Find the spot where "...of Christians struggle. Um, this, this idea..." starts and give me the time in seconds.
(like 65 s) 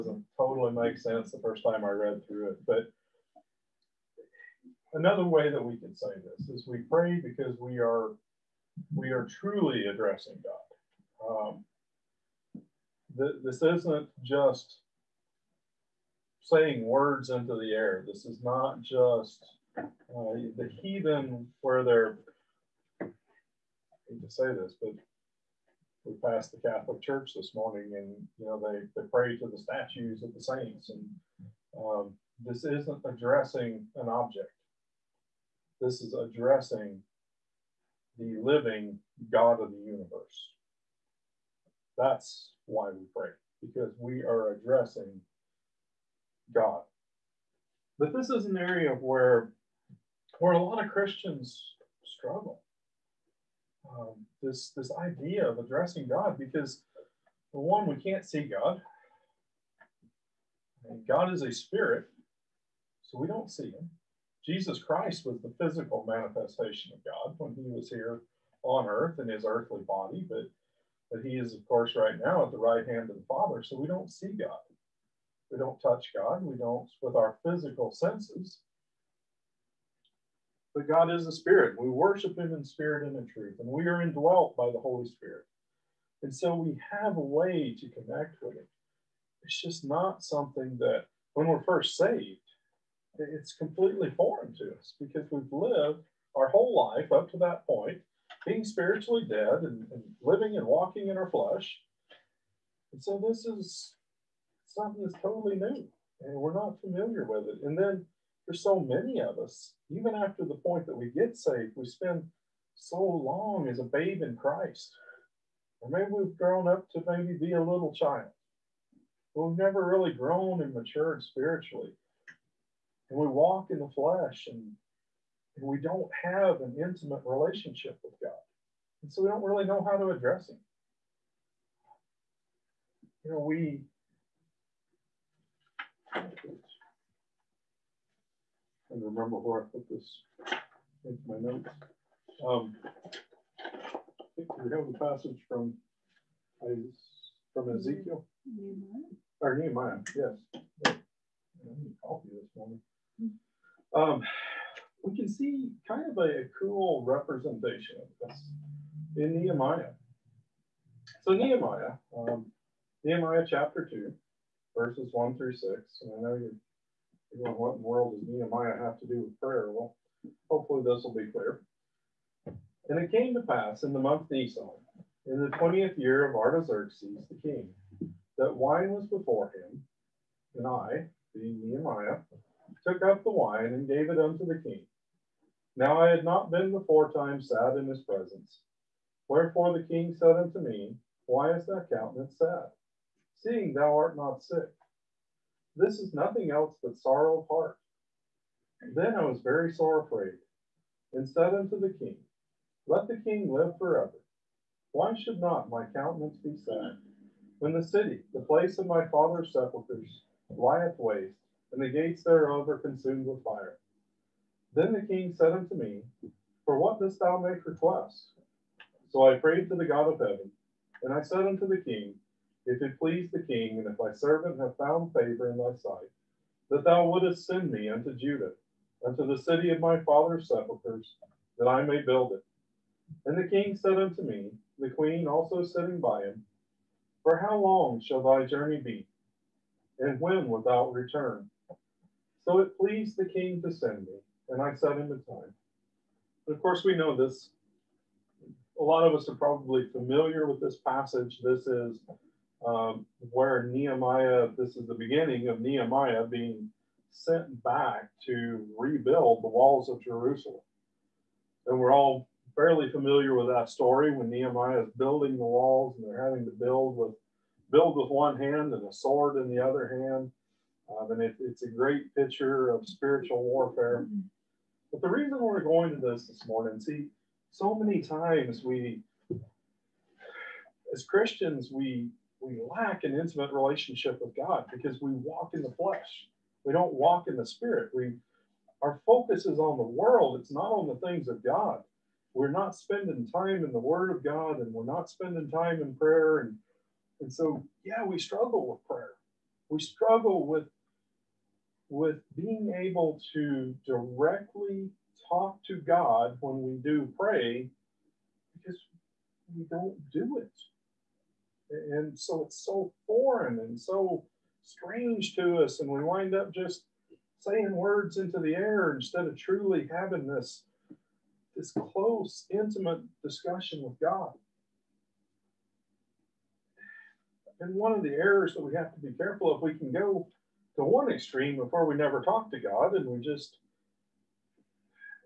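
50 s.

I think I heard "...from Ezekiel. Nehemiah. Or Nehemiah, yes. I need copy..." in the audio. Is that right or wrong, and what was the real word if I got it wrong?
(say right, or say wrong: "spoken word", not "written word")
right.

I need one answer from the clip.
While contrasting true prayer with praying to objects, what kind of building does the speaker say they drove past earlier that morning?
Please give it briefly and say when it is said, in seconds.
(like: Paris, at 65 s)
Catholic Church, at 26 s.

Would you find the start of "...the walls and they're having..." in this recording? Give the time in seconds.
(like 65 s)
265 s.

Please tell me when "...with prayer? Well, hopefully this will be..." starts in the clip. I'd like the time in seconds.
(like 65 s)
169 s.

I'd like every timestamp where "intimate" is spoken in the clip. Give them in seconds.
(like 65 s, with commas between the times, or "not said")
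126 s, 283 s, 322 s.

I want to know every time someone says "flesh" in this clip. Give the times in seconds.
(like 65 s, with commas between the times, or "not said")
101 s, 123 s, 285 s.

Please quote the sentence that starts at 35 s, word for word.
This is addressing the living God of the universe.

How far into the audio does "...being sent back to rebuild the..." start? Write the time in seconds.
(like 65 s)
256 s.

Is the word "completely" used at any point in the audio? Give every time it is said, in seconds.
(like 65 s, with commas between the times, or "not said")
93 s.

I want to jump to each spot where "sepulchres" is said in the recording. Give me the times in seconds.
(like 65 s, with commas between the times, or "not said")
209 s, 230 s.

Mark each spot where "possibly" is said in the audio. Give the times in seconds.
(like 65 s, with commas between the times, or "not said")
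not said.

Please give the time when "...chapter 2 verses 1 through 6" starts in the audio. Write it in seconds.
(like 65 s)
163 s.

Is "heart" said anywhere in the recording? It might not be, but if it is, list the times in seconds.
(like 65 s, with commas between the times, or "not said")
197 s.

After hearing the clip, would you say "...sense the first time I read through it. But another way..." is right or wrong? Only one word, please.
right.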